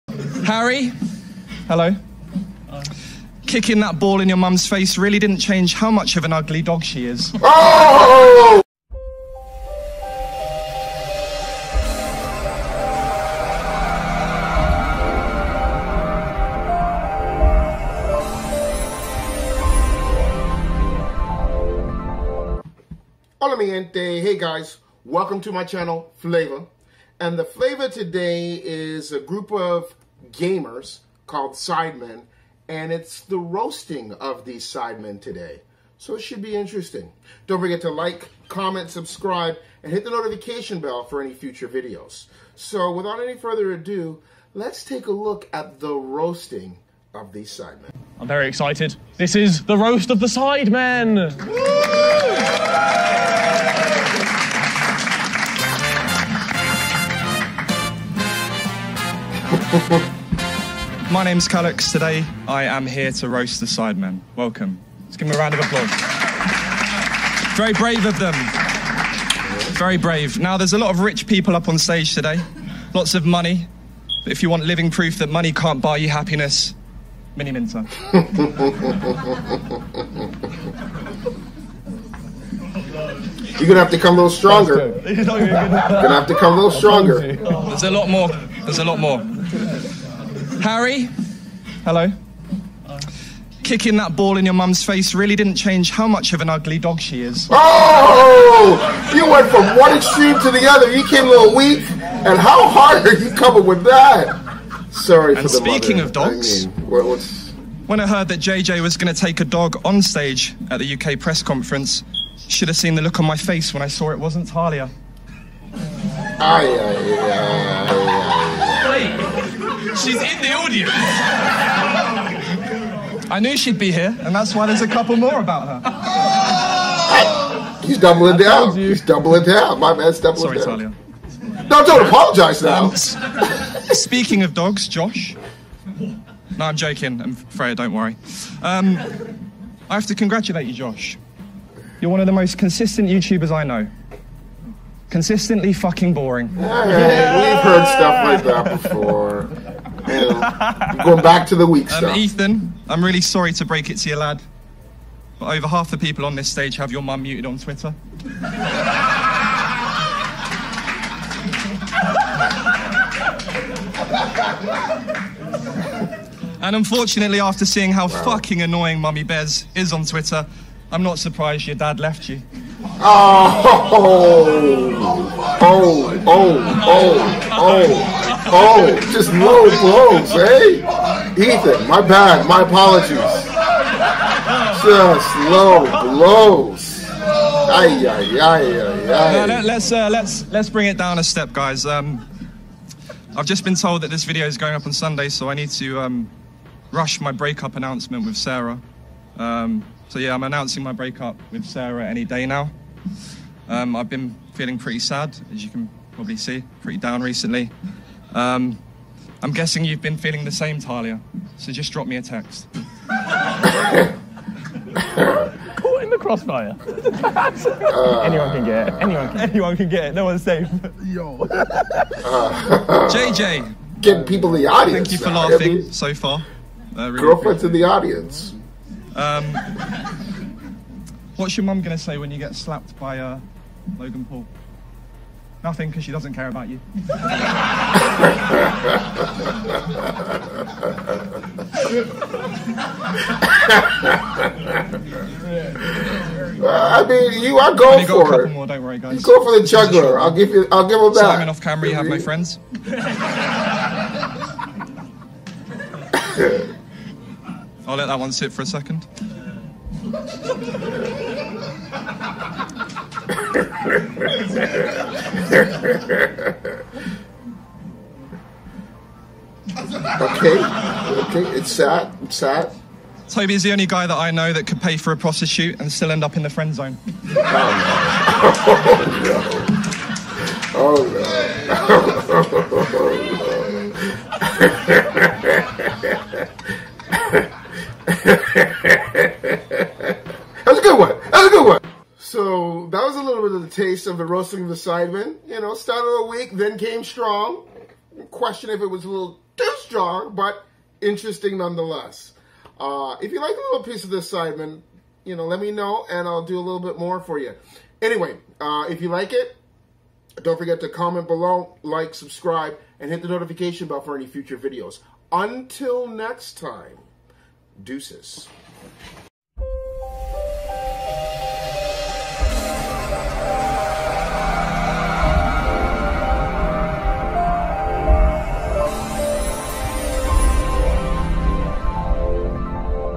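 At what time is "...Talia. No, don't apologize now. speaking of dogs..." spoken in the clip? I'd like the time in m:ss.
2:10.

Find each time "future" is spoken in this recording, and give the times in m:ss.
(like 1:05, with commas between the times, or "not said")
0:41, 5:14.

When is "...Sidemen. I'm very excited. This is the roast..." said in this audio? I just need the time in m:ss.
0:47.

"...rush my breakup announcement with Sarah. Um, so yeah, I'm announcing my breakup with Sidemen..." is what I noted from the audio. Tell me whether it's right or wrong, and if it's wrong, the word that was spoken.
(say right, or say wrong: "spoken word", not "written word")
wrong: "Sarah", not "Sidemen".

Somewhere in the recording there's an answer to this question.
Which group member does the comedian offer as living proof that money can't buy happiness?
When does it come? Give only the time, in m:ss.
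1:17.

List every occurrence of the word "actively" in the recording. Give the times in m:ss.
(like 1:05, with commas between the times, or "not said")
not said.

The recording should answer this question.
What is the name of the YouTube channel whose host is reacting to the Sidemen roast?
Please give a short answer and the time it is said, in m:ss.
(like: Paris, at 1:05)
Phlava, at 0:26.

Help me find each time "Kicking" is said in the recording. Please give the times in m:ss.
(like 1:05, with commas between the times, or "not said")
0:03, 1:33.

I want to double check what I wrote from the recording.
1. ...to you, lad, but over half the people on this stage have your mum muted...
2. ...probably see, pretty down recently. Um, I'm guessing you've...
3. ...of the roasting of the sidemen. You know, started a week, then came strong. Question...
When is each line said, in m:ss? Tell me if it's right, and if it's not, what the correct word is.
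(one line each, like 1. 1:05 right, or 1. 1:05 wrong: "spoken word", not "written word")
1. 2:33 right
2. 3:26 right
3. 4:54 right.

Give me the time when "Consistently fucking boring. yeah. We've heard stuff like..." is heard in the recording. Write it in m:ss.
2:25.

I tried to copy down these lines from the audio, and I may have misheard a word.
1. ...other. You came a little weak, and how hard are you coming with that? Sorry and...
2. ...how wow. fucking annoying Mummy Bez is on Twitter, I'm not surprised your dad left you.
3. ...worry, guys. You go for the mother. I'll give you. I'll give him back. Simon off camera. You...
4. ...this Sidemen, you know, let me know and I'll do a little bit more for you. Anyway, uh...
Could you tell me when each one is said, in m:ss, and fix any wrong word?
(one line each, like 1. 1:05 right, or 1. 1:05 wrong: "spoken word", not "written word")
1. 1:40 right
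2. 2:47 right
3. 4:08 wrong: "juggler", not "mother"
4. 5:04 right.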